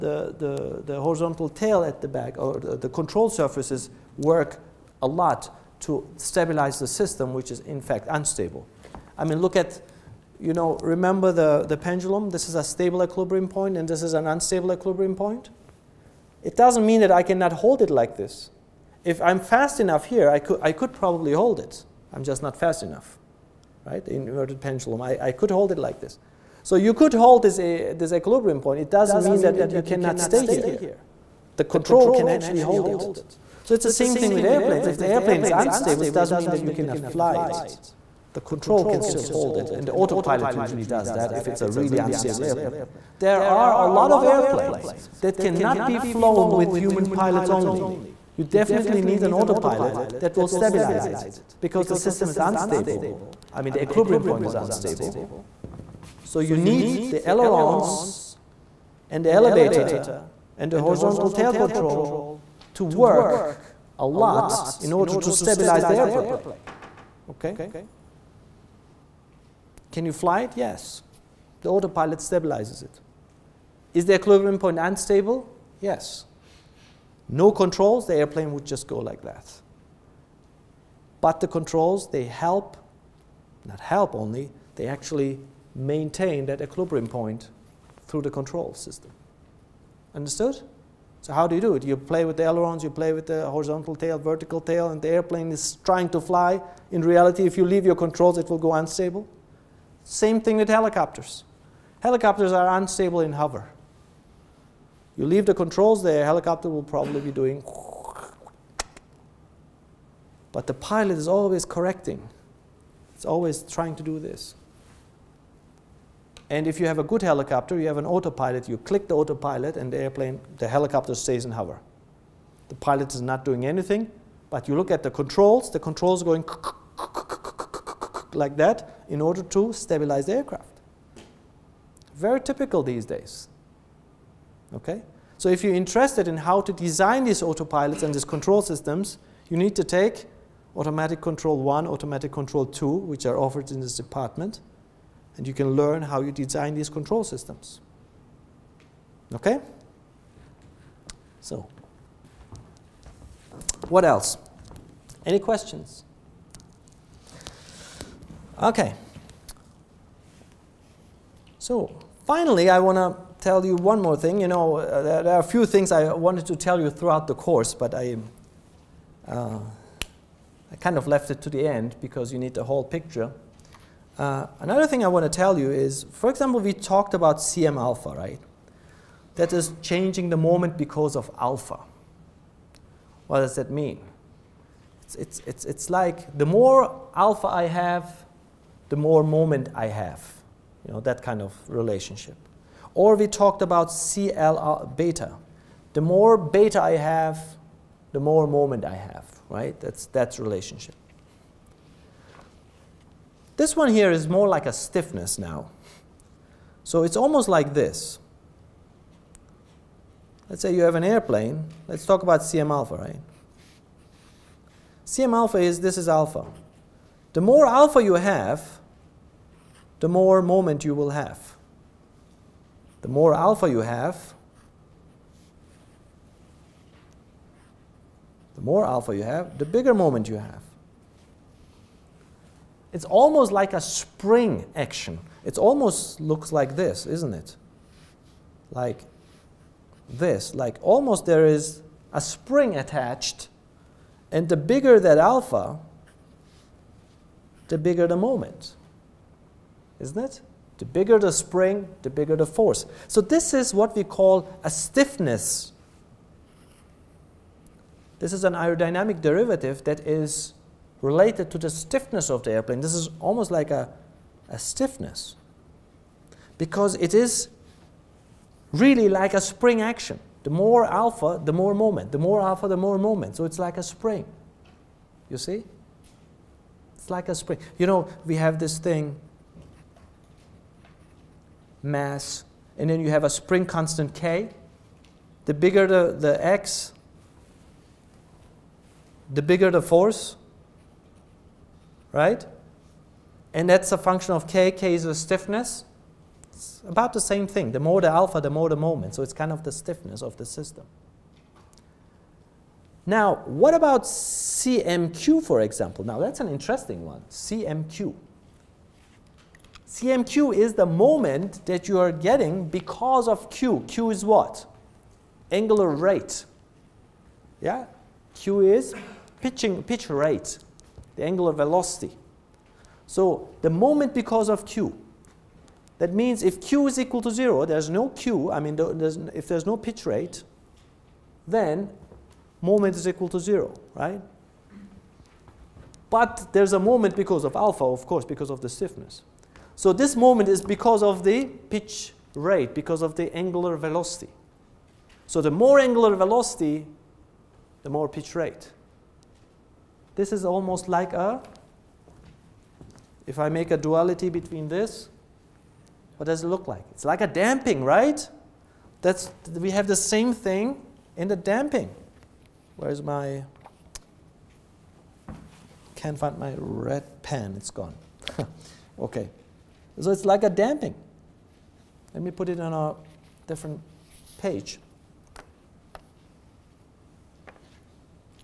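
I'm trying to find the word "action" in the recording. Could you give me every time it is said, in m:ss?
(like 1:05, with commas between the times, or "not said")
3:54, 4:29.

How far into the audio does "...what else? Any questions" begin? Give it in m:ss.
2:33.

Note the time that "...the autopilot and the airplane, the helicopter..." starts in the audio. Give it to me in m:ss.
1:59.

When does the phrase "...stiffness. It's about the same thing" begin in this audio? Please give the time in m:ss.
4:55.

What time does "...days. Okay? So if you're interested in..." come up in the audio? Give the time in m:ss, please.
2:13.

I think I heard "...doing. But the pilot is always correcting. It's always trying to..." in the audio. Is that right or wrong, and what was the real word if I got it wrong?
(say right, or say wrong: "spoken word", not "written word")
right.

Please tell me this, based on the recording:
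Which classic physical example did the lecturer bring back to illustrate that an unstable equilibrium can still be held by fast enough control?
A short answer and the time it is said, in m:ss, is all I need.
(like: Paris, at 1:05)
The pendulum, at 0:11.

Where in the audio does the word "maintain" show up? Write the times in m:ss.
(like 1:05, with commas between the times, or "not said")
1:25.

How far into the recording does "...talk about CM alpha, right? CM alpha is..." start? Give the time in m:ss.
3:32.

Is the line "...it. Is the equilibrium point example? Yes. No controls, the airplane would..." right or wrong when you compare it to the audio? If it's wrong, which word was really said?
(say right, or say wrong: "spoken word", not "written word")
wrong: "unstable", not "example".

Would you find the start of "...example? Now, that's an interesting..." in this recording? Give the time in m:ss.
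5:05.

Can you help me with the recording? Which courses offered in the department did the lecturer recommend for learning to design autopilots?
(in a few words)
Automatic control 1 and 2.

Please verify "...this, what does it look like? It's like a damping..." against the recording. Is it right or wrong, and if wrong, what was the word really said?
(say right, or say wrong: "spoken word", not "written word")
right.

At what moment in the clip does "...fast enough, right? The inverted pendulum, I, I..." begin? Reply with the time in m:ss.
0:22.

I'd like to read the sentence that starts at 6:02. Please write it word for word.
Where's my, can't find my red pen, it's gone.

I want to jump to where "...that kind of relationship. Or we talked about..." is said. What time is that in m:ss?
3:11.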